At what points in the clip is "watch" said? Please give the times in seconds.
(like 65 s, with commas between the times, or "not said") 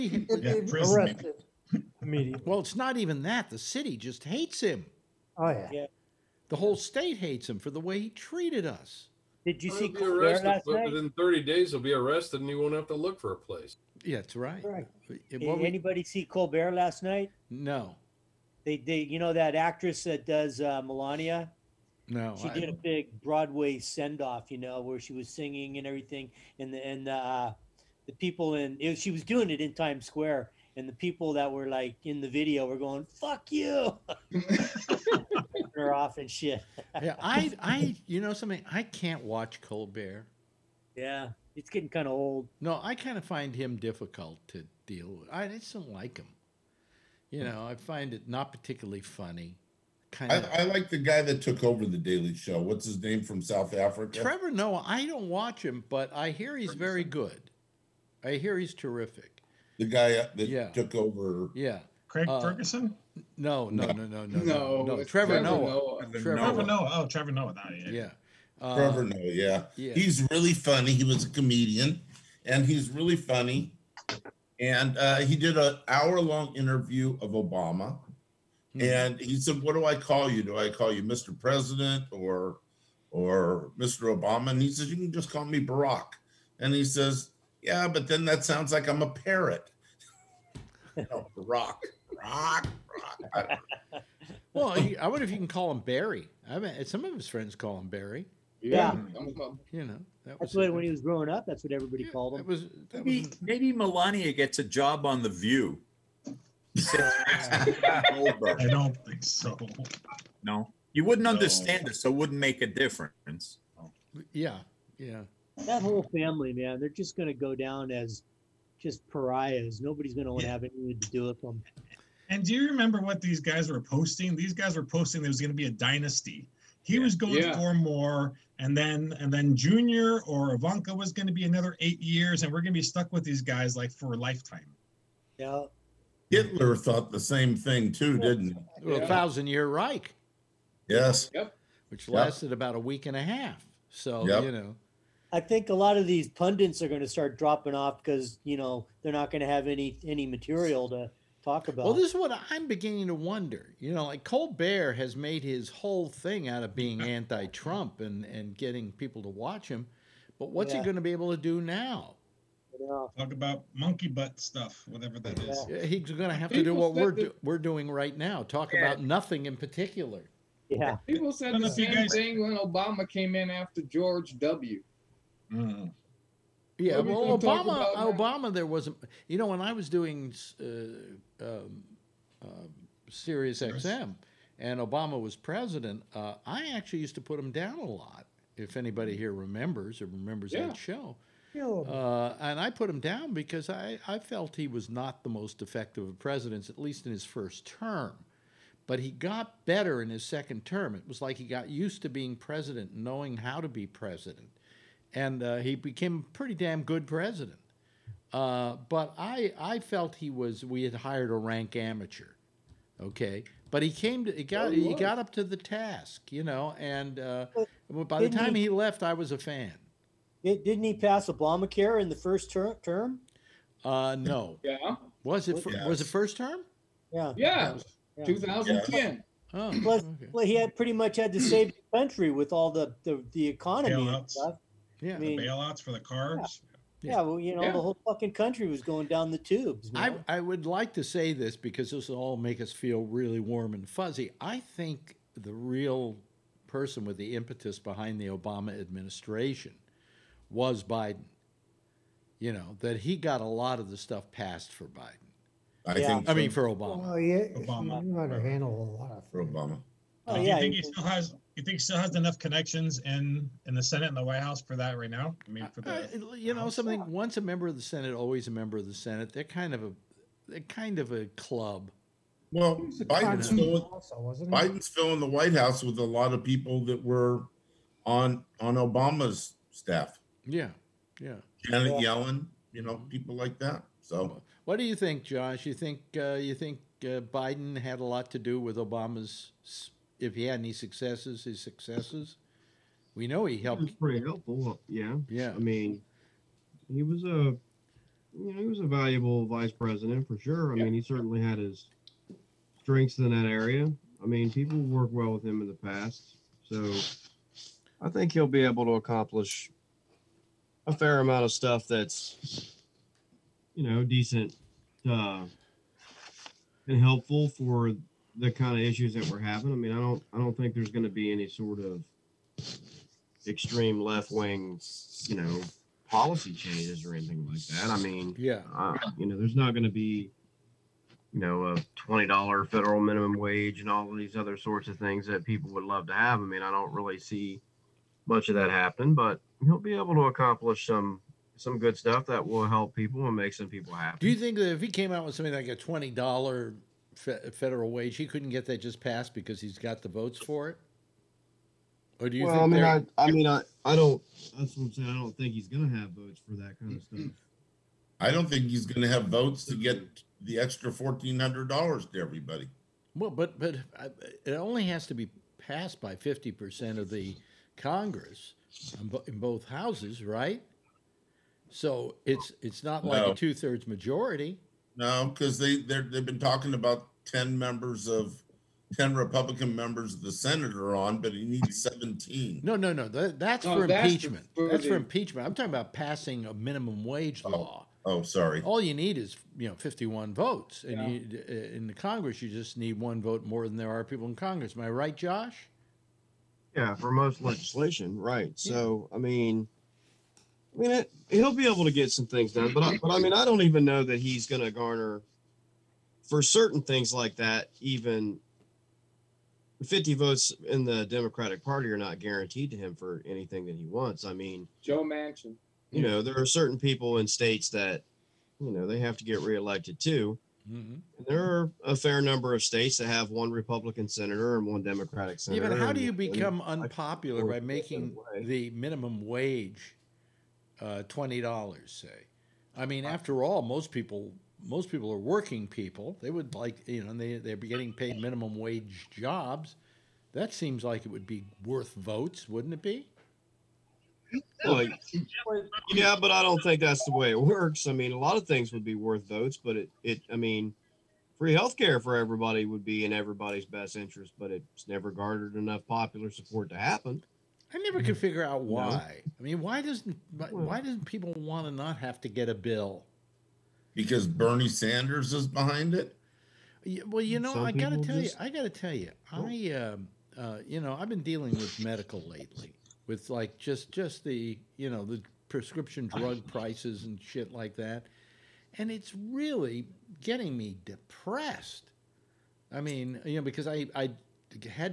39 s, 55 s, 159 s.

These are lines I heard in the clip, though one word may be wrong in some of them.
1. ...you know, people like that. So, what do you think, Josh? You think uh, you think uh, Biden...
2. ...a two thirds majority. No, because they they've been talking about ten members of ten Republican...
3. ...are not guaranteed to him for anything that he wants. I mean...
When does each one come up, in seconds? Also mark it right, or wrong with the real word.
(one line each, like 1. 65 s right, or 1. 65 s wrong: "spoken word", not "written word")
1. 282 s right
2. 373 s right
3. 411 s right.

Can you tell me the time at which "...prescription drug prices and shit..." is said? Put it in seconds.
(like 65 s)
475 s.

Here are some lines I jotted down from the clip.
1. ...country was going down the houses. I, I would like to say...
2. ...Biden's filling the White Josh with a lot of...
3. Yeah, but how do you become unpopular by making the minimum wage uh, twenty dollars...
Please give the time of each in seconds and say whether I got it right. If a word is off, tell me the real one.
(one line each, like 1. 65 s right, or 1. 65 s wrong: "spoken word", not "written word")
1. 238 s wrong: "tubes", not "houses"
2. 274 s wrong: "House", not "Josh"
3. 425 s right.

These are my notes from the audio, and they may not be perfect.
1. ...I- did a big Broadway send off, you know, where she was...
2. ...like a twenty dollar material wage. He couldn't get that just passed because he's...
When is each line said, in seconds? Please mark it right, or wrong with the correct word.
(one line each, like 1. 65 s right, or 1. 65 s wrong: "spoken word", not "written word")
1. 22 s right
2. 345 s wrong: "federal", not "material".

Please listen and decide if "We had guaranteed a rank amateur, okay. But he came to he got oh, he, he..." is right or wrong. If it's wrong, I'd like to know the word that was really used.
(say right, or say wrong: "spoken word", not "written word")
wrong: "hired", not "guaranteed".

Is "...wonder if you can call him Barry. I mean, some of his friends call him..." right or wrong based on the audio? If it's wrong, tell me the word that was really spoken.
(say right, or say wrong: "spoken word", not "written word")
right.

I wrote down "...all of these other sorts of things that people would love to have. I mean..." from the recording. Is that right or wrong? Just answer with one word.
right.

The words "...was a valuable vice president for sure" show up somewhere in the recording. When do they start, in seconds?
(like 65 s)
298 s.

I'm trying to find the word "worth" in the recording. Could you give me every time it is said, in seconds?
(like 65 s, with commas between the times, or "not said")
441 s, 448 s.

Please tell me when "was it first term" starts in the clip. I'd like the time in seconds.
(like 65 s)
225 s.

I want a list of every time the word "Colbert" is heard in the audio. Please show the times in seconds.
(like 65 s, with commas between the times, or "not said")
16 s, 39 s, 154 s.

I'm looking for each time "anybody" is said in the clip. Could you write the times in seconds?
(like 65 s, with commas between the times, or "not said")
15 s, 188 s.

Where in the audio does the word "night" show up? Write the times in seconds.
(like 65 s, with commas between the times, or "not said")
10 s, 17 s.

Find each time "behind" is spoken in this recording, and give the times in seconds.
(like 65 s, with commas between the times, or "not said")
247 s, 465 s.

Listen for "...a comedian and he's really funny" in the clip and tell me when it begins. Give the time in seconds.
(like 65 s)
71 s.